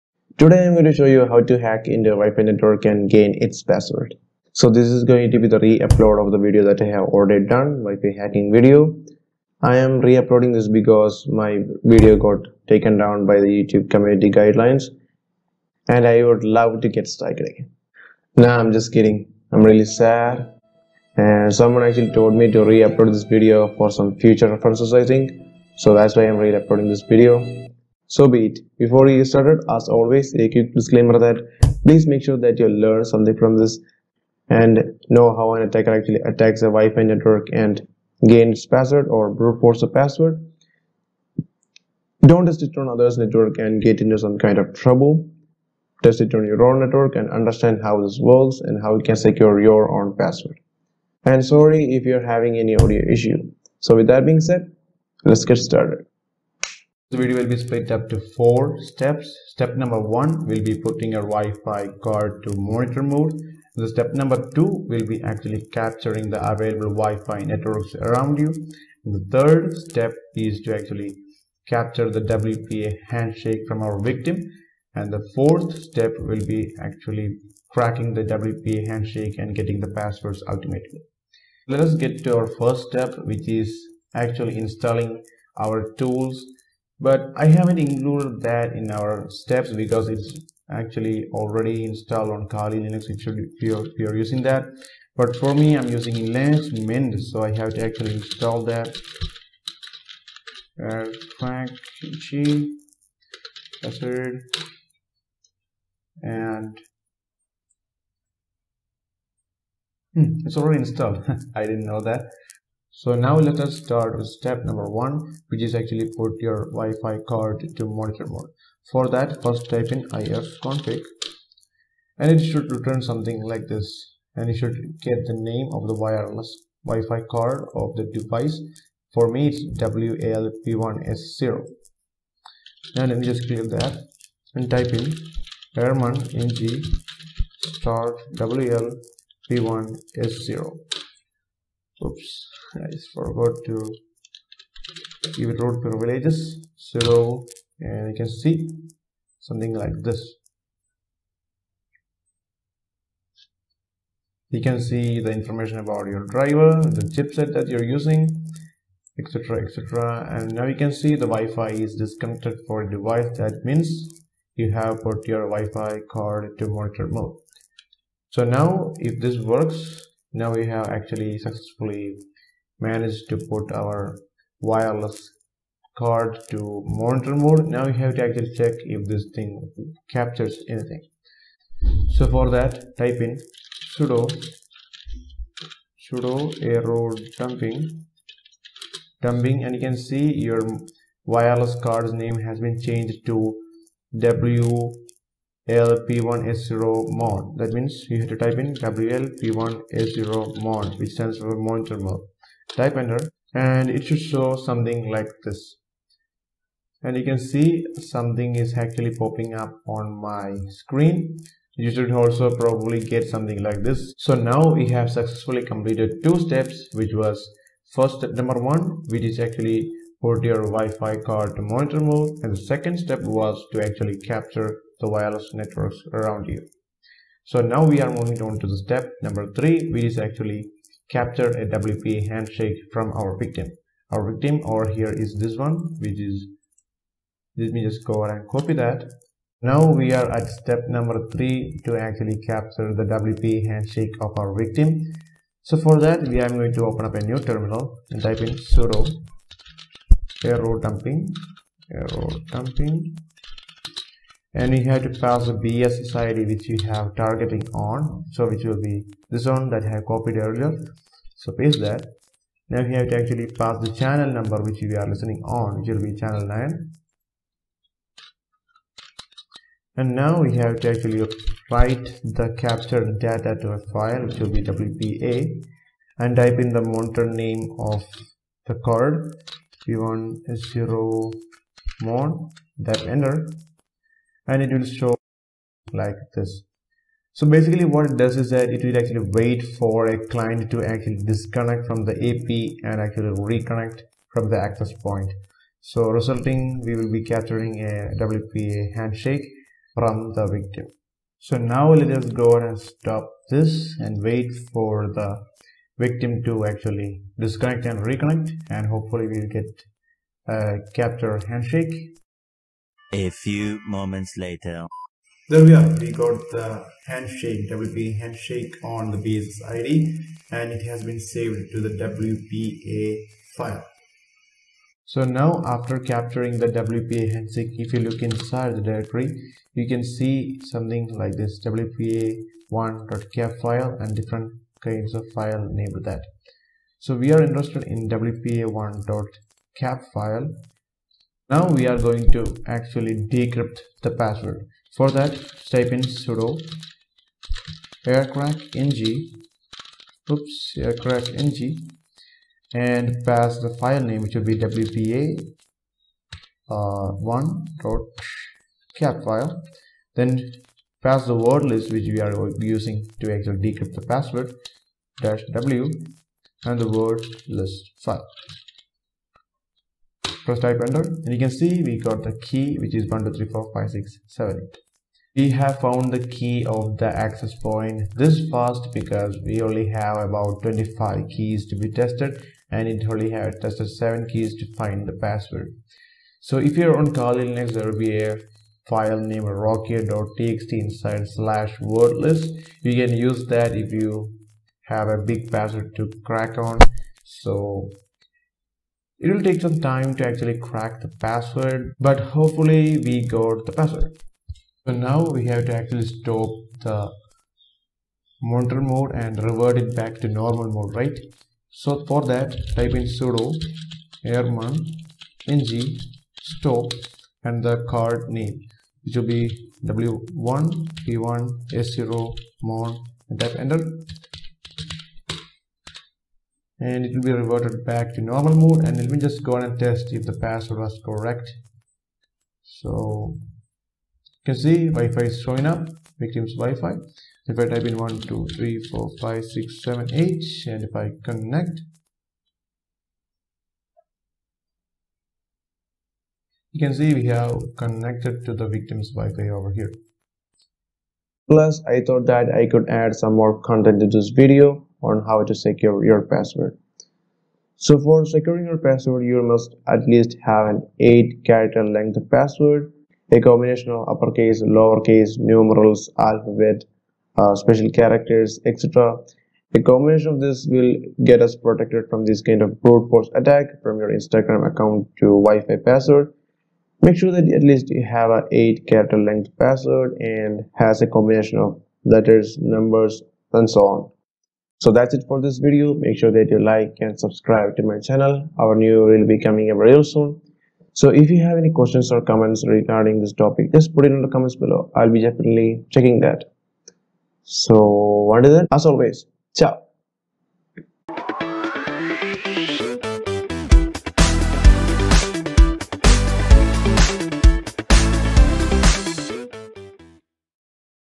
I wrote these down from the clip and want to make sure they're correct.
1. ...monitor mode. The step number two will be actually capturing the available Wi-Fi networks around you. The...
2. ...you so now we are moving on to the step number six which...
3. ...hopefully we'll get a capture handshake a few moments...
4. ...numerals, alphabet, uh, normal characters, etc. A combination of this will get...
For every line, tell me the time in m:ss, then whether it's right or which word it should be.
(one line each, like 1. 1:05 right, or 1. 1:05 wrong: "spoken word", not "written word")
1. 1:02 right
2. 3:46 wrong: "three", not "six"
3. 5:08 right
4. 7:45 wrong: "special", not "normal".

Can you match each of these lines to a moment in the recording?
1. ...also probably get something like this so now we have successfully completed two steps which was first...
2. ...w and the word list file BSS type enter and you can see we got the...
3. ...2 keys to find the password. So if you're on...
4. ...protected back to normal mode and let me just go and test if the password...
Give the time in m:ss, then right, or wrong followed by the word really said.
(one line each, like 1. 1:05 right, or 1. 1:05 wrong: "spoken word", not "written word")
1. 3:32 right
2. 6:05 wrong: "First", not "BSS"
3. 6:23 wrong: "7", not "2"
4. 7:07 wrong: "reverted", not "protected".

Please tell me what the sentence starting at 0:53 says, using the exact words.
So with that being said, let's get started.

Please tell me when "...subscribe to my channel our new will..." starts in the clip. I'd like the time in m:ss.
8:07.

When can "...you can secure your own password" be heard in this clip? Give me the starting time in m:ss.
0:48.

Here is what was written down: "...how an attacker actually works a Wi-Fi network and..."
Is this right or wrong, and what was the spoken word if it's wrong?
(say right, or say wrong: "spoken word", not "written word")
wrong: "attacks", not "works".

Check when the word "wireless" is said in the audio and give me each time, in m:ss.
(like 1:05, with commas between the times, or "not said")
2:05, 2:54, 3:11, 3:45.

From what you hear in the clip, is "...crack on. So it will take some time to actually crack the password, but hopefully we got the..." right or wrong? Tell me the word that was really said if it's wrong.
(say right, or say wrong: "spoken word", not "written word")
right.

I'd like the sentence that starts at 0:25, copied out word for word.
So that's why I'm re-uploading this video.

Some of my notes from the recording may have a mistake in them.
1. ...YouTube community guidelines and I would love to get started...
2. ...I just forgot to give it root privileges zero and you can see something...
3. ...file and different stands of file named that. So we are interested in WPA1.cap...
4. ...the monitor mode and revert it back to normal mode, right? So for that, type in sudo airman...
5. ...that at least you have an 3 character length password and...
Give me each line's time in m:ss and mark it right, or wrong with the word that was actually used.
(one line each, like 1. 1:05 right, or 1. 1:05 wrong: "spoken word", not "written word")
1. 0:13 right
2. 2:22 right
3. 5:33 wrong: "kinds", not "stands"
4. 6:46 right
5. 7:57 wrong: "8", not "3".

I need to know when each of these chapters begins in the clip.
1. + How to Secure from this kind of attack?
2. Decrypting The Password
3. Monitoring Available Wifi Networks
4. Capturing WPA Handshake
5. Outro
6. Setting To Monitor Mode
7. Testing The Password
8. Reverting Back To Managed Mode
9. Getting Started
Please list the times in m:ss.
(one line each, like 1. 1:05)
1. 7:31
2. 5:26
3. 3:01
4. 3:49
5. 8:04
6. 1:53
7. 7:09
8. 6:25
9. 0:56.